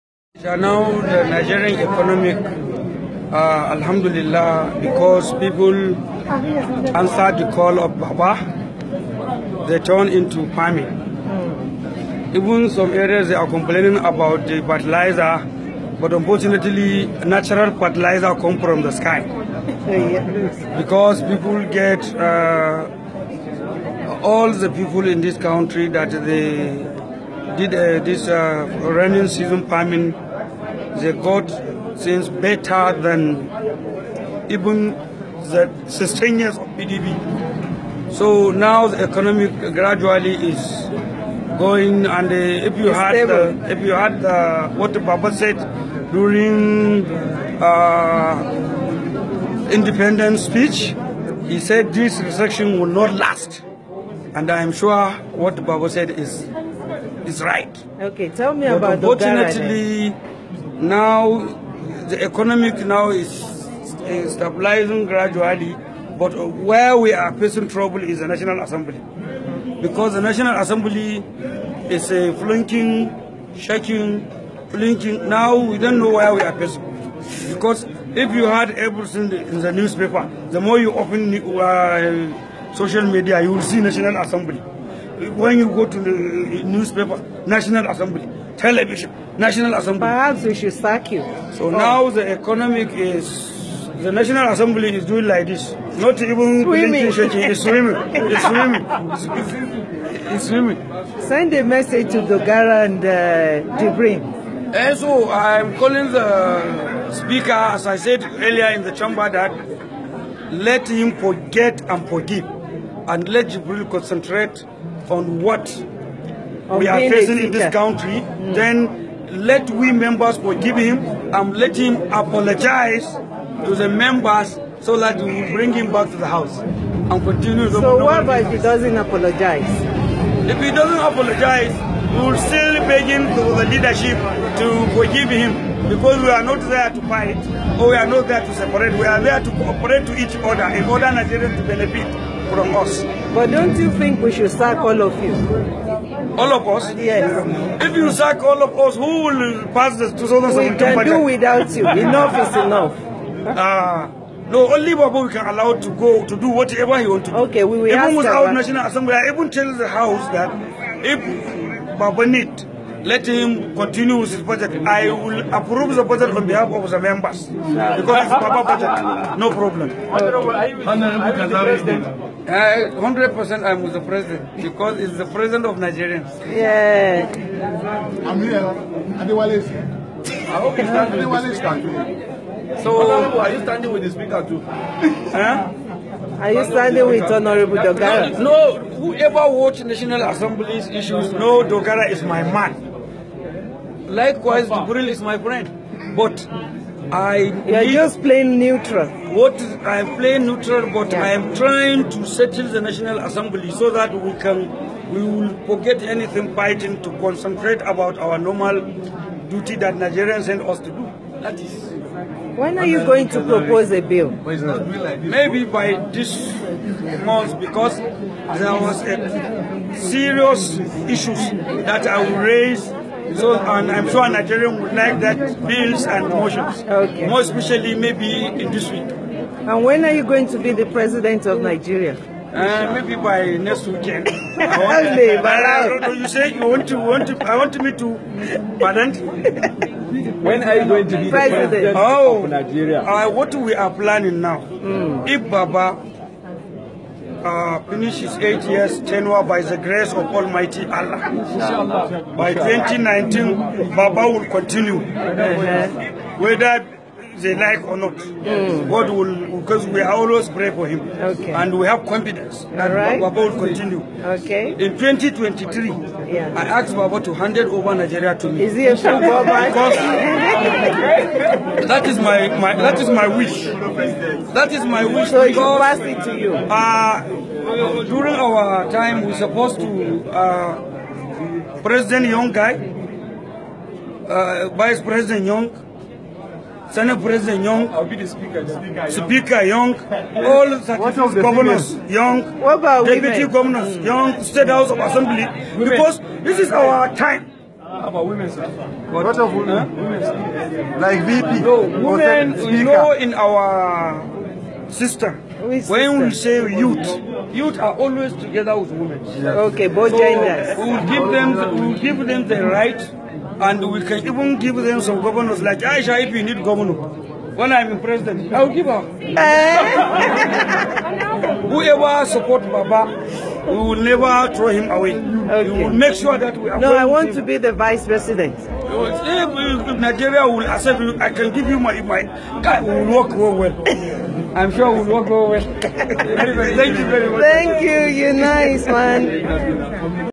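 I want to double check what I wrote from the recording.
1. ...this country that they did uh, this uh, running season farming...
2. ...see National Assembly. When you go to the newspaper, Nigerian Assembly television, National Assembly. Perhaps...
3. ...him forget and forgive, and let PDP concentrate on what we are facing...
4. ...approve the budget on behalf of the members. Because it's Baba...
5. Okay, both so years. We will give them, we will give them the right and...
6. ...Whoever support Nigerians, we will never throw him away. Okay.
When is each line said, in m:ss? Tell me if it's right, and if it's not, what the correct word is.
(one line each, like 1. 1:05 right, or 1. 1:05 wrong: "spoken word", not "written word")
1. 0:25 right
2. 1:23 wrong: "National", not "Nigerian"
3. 1:50 wrong: "Jibril", not "PDP"
4. 2:45 right
5. 5:09 wrong: "genders", not "years"
6. 5:21 wrong: "Baba", not "Nigerians".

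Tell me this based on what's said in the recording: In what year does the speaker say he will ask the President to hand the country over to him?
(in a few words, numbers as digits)
2023.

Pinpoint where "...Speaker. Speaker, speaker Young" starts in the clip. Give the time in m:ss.
4:48.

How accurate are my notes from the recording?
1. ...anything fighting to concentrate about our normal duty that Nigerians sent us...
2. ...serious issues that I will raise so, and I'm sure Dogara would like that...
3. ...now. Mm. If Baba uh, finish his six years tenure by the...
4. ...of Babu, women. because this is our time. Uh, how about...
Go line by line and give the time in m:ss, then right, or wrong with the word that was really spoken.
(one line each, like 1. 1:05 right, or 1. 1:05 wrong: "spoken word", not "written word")
1. 3:26 right
2. 3:39 wrong: "Nigerians", not "Dogara"
3. 4:04 wrong: "eight", not "six"
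4. 4:54 wrong: "Assembly", not "Babu".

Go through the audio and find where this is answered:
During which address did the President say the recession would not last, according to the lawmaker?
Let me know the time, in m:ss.
0:49.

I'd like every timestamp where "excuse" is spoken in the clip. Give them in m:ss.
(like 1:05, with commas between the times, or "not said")
not said.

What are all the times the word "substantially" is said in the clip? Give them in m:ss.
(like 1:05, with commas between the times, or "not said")
not said.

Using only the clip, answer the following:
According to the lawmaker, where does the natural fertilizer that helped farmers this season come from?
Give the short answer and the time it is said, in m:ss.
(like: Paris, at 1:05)
The sky, at 0:18.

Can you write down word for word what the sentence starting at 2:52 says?
I, uh, 100% I'm with the president because it's the president of Nigerians.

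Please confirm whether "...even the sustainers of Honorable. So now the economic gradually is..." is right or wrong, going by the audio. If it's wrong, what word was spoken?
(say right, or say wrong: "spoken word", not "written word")
wrong: "PDP", not "Honorable".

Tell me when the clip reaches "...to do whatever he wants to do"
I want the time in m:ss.
2:36.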